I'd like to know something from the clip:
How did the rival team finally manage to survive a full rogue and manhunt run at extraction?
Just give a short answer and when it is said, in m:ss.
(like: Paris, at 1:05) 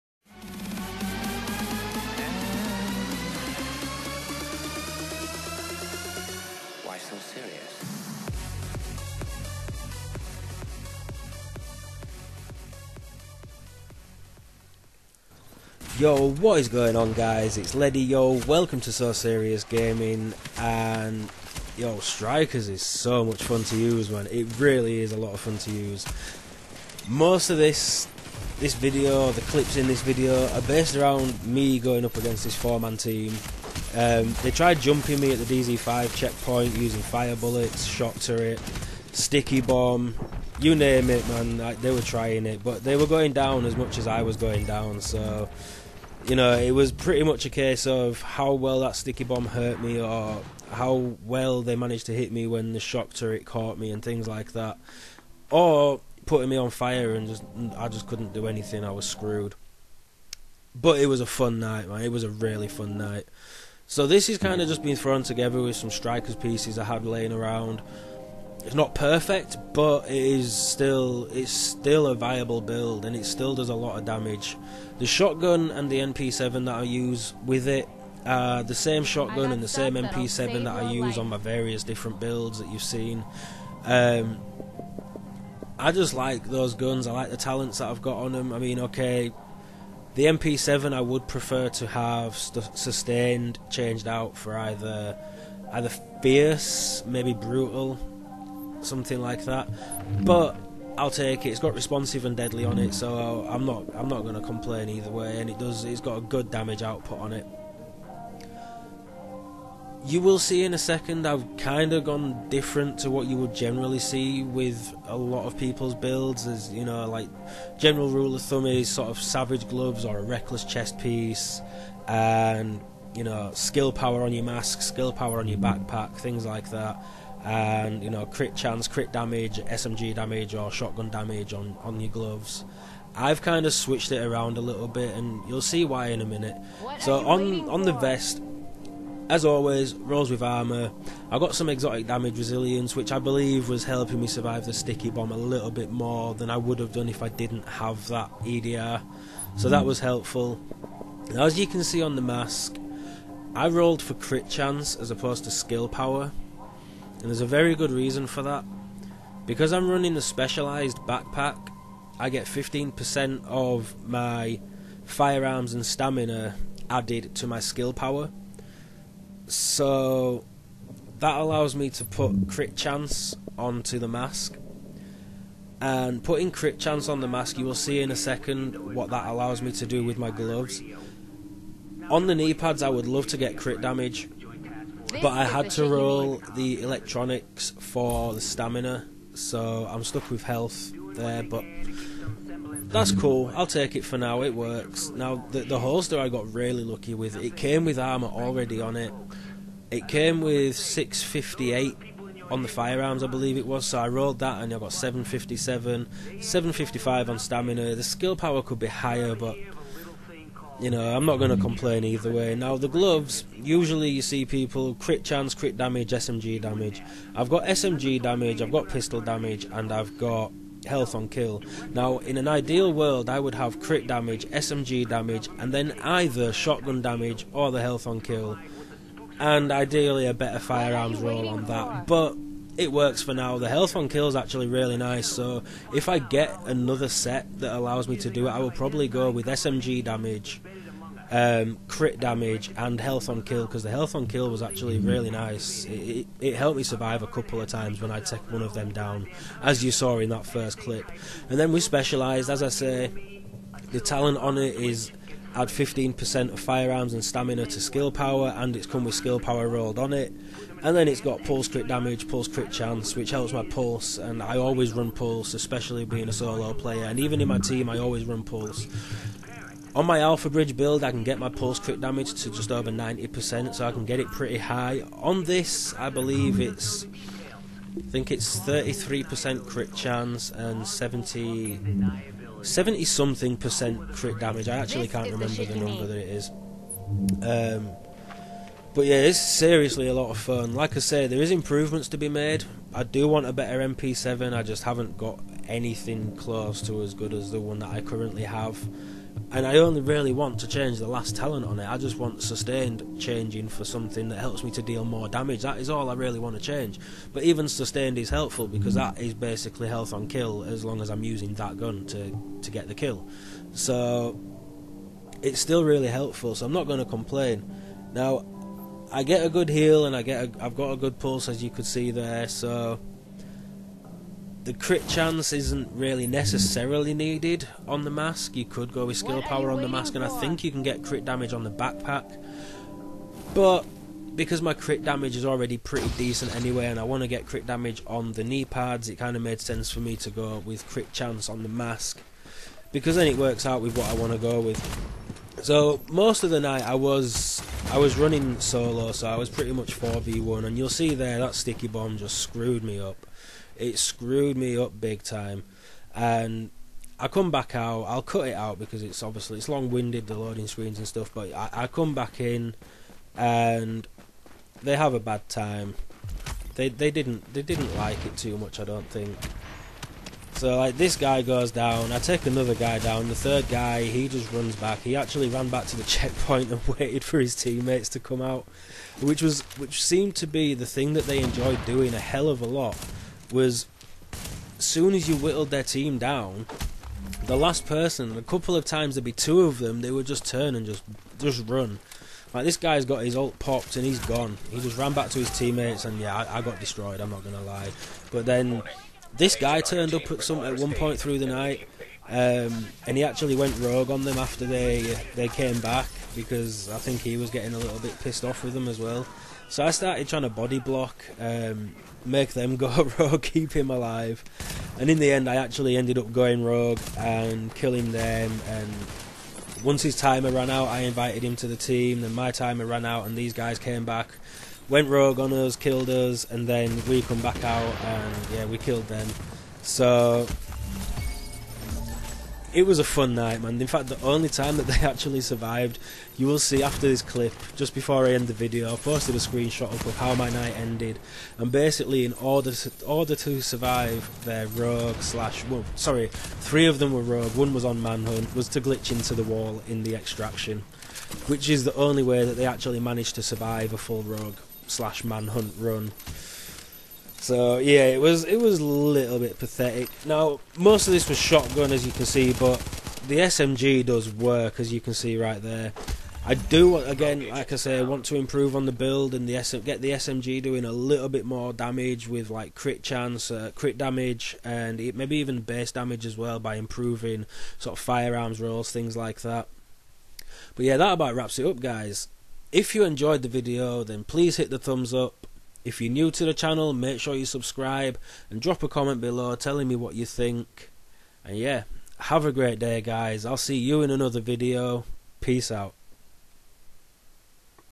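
glitch into the wall, at 7:28.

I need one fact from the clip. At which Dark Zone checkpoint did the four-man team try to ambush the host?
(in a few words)
DZ5.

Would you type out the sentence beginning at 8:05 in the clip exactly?
If you're new to the channel, make sure you subscribe and drop a comment below telling me what you think.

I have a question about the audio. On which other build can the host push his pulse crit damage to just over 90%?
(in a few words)
Alpha Bridge.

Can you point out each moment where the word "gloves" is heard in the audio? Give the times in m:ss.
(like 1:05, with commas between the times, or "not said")
1:59, 2:12, 3:00, 3:32.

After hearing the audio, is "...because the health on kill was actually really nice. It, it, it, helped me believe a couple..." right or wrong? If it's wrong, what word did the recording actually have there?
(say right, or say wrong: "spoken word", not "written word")
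wrong: "survive", not "believe".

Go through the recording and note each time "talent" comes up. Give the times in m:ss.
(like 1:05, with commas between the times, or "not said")
1:27, 4:13, 5:01.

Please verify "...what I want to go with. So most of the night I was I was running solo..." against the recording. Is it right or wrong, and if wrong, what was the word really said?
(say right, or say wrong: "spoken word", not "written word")
right.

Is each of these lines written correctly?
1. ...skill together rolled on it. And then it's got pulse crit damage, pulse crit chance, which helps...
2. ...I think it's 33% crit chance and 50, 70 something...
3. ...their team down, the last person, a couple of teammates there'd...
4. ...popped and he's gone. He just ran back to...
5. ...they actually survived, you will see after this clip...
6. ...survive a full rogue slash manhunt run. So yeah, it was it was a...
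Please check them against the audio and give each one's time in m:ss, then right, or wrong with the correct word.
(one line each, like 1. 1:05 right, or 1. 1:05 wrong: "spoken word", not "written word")
1. 4:19 wrong: "power", not "together"
2. 4:37 wrong: "70", not "50"
3. 6:25 wrong: "times", not "teammates"
4. 6:33 right
5. 7:14 right
6. 7:33 right.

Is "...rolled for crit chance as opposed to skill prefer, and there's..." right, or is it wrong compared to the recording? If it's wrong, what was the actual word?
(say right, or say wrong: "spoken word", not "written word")
wrong: "power", not "prefer".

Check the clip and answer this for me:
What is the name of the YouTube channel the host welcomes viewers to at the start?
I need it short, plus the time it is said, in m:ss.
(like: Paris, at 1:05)
So Serious Gaming, at 0:18.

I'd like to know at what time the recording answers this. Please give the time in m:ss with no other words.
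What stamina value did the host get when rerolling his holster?
3:26.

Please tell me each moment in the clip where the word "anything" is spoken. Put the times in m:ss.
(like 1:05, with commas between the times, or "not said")
0:58, 4:55.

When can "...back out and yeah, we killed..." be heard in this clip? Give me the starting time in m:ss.
7:07.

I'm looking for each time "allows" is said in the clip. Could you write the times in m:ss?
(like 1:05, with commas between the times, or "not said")
2:51, 2:59, 3:57.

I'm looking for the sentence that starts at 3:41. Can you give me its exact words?
Now, in an ideal world, I would have crit damage, SMG damage, and then either shotgun damage or the health on kill.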